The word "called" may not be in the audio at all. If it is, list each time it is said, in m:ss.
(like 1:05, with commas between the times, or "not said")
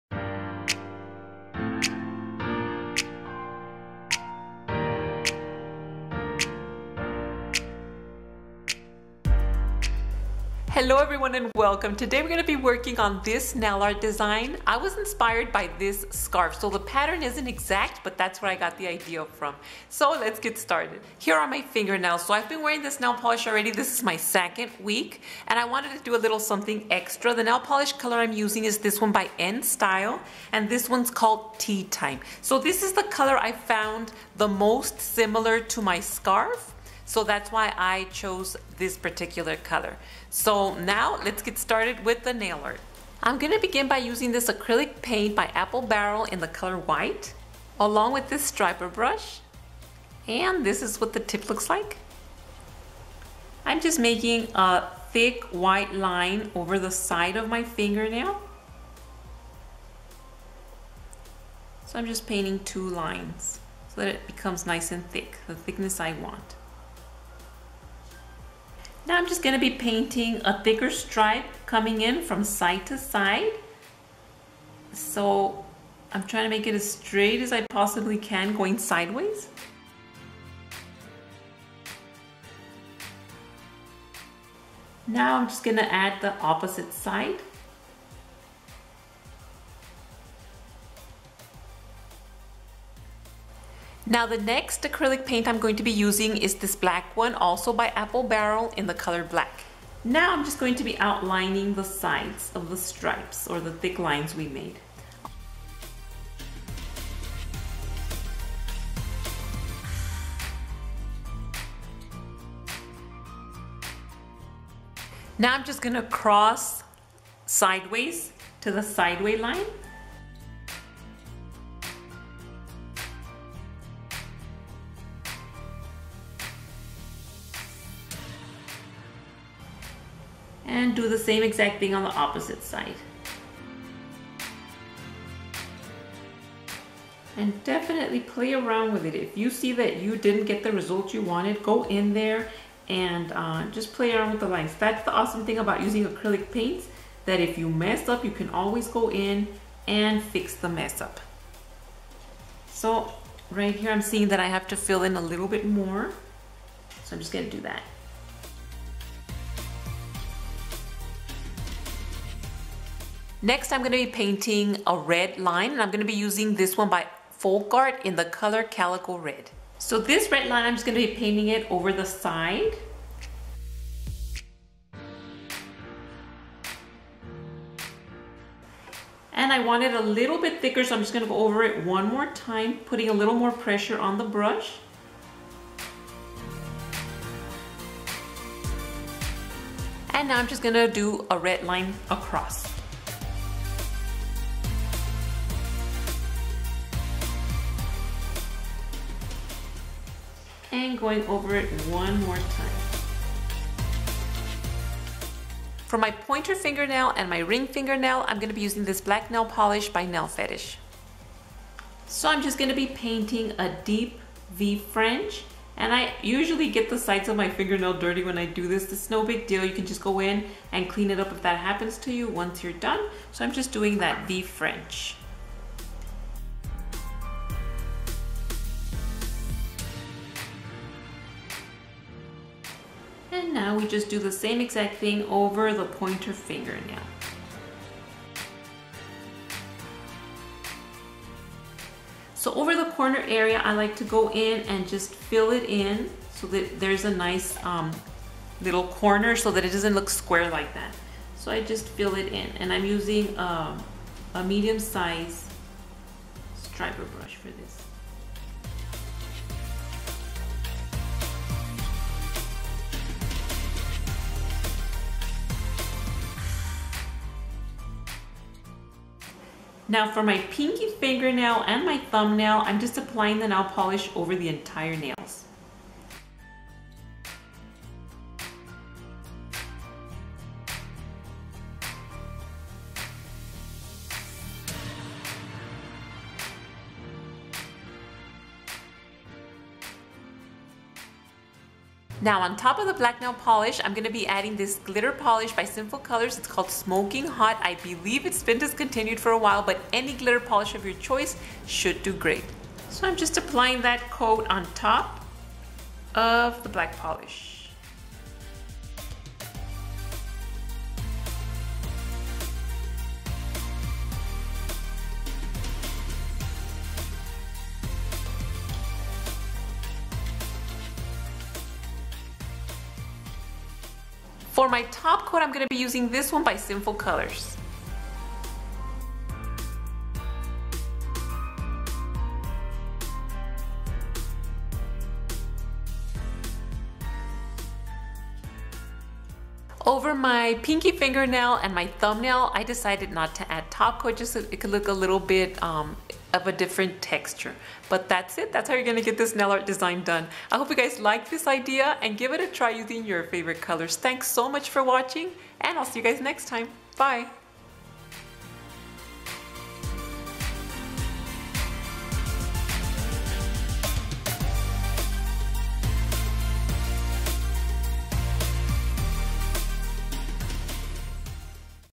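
0:31, 4:56.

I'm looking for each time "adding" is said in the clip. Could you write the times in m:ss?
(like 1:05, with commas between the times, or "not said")
4:54.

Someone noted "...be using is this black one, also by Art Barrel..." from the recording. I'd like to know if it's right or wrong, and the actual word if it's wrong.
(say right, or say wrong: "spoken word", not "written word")
wrong: "Apple", not "Art".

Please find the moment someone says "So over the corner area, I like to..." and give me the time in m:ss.
4:02.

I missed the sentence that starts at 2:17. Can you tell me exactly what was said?
And definitely play around with it.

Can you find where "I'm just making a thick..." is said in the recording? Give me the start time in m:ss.
0:53.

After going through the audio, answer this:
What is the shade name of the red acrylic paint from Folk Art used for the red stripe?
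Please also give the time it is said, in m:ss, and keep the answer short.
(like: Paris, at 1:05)
Calico Red, at 2:48.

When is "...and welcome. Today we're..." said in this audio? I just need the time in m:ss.
0:11.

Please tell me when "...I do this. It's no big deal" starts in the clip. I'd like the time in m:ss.
3:38.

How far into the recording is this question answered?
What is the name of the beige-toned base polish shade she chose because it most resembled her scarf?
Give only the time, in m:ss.
0:31.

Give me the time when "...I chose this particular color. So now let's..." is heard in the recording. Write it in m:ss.
0:37.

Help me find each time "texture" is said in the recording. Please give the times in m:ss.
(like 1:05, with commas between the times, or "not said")
5:47.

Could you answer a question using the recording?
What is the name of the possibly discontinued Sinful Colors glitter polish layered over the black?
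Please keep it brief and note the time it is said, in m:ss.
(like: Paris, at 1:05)
Smoking Hot, at 4:56.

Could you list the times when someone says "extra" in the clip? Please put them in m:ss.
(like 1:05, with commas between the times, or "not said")
0:26.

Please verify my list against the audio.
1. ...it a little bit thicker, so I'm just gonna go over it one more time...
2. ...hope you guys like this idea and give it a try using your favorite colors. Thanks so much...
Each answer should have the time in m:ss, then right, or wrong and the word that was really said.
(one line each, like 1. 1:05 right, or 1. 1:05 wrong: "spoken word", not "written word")
1. 2:59 right
2. 5:50 right.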